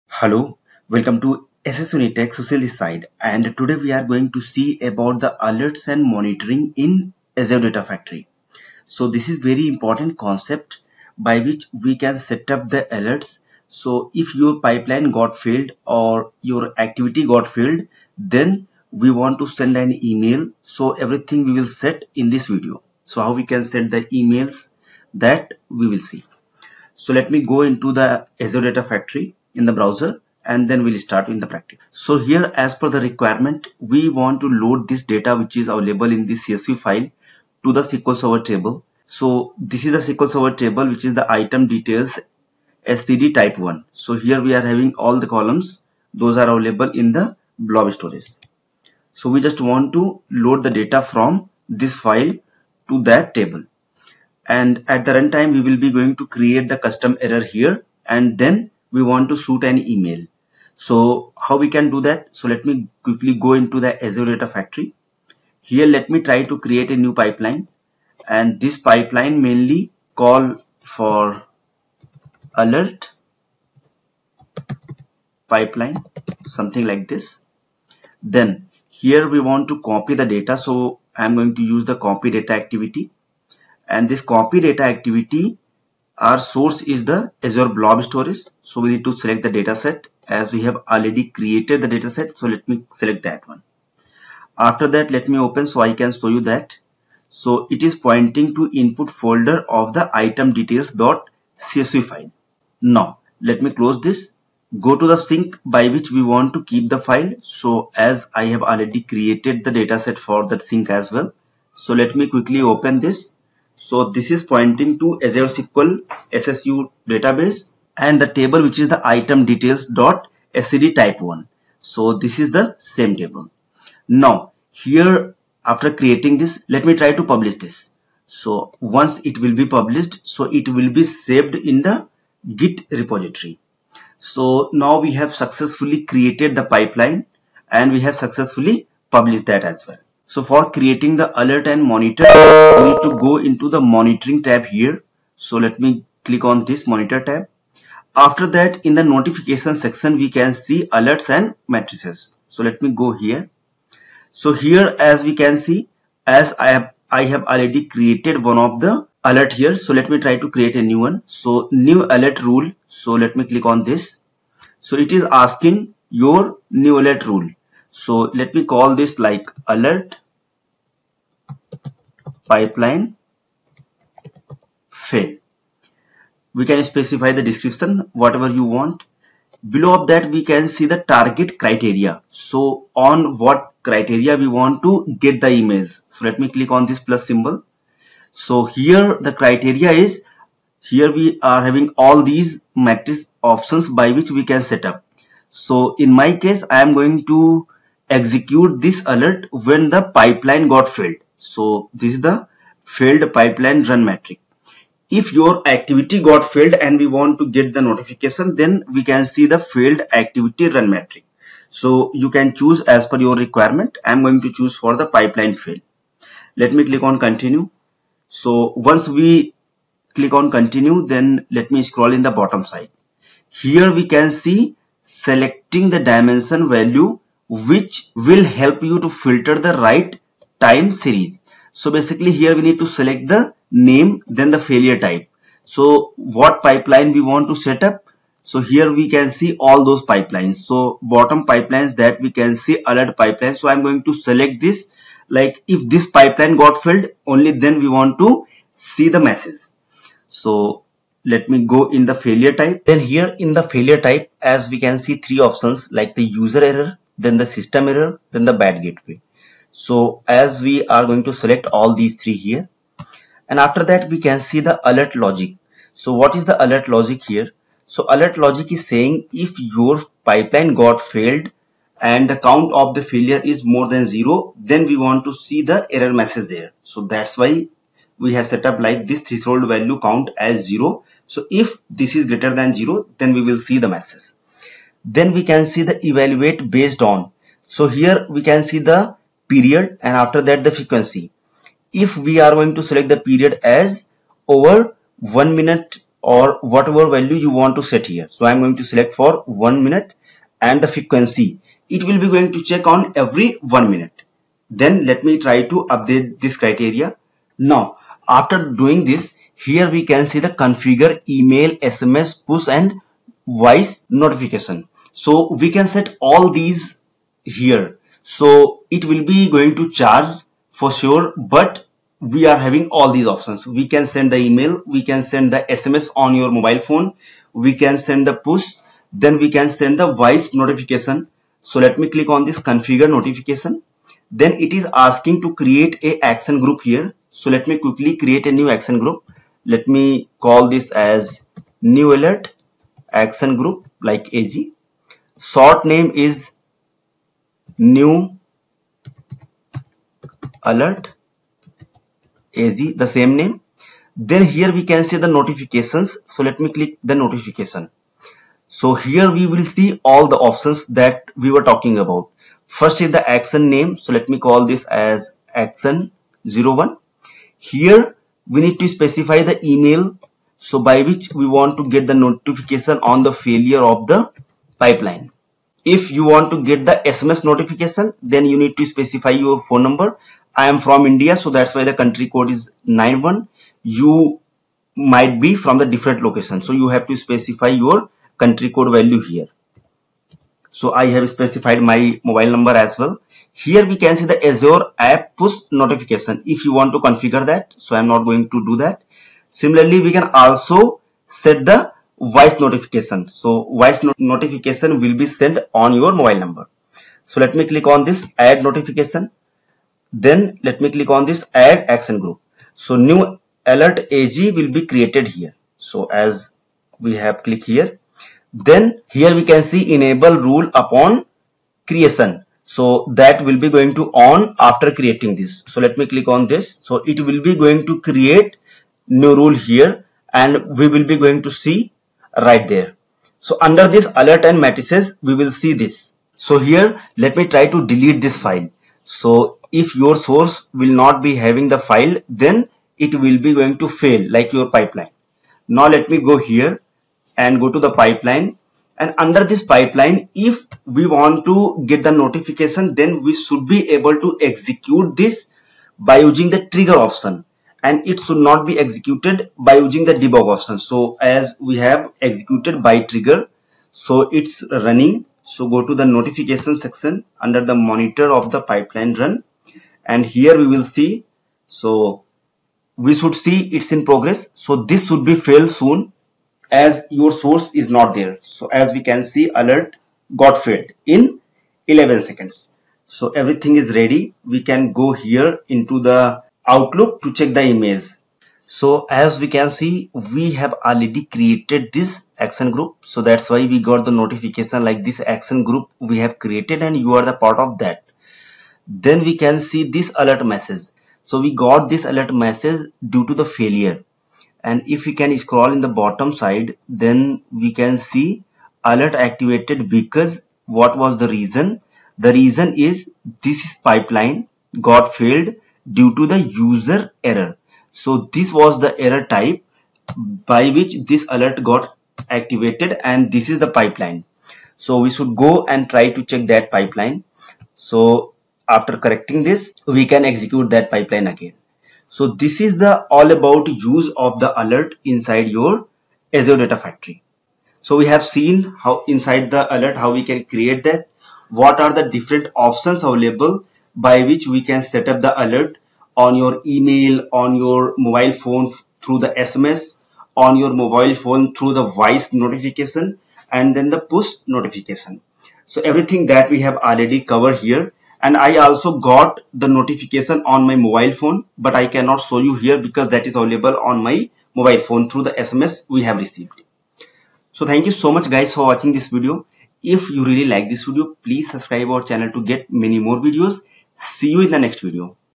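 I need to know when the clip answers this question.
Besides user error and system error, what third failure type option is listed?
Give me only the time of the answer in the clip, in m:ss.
4:18.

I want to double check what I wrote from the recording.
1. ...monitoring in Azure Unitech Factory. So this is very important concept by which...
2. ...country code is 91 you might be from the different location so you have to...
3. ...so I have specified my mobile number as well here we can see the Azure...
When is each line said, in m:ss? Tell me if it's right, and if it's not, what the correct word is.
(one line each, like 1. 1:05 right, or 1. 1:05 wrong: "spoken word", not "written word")
1. 0:06 wrong: "Data", not "Unitech"
2. 6:21 right
3. 6:30 right.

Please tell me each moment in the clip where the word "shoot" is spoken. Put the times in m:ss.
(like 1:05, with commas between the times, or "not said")
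0:59.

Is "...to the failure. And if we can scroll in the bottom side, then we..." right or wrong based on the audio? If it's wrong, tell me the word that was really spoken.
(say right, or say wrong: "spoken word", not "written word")
right.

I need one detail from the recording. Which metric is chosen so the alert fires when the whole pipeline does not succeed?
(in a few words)
failed pipeline run metric.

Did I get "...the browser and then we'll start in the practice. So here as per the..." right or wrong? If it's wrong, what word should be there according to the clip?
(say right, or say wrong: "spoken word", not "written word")
right.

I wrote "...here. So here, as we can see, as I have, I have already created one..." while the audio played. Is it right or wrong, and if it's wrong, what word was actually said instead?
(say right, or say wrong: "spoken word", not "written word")
right.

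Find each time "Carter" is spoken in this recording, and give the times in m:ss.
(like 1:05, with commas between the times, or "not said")
not said.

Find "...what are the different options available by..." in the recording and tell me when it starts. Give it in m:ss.
9:01.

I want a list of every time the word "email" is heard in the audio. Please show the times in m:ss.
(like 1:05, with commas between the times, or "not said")
0:20, 0:24, 0:59, 5:11, 5:24, 6:09, 9:06.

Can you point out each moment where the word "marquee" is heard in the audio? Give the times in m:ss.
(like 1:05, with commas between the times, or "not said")
not said.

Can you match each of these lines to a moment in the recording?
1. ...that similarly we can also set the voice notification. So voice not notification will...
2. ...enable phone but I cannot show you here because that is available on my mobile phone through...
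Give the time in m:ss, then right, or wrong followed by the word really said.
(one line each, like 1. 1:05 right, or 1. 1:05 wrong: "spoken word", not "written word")
1. 6:38 right
2. 9:20 wrong: "mobile", not "enable".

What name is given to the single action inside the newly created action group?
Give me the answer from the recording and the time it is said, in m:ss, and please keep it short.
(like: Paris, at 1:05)
action 01, at 6:05.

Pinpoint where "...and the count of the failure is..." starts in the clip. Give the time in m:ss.
4:32.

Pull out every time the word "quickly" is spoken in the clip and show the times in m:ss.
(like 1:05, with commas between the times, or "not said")
1:03, 1:52, 5:37.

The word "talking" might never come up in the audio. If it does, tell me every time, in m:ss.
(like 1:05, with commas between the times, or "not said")
6:01.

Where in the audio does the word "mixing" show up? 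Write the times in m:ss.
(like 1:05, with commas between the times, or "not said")
not said.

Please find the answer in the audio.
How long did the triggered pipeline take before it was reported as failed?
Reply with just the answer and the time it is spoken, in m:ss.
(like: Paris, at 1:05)
11 seconds, at 8:01.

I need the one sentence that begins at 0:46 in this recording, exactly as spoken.
Those are available in the blob storage.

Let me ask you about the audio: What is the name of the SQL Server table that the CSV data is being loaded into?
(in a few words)
item details SCD type 1.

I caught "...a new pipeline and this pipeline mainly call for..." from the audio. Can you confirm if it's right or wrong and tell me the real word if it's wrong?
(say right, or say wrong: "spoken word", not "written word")
right.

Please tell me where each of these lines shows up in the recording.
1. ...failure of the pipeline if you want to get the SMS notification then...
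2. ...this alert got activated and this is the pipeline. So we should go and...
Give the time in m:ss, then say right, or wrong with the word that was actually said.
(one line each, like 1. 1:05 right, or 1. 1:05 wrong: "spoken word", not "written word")
1. 6:13 right
2. 8:41 right.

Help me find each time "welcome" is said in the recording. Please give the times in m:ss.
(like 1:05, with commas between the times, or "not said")
0:00.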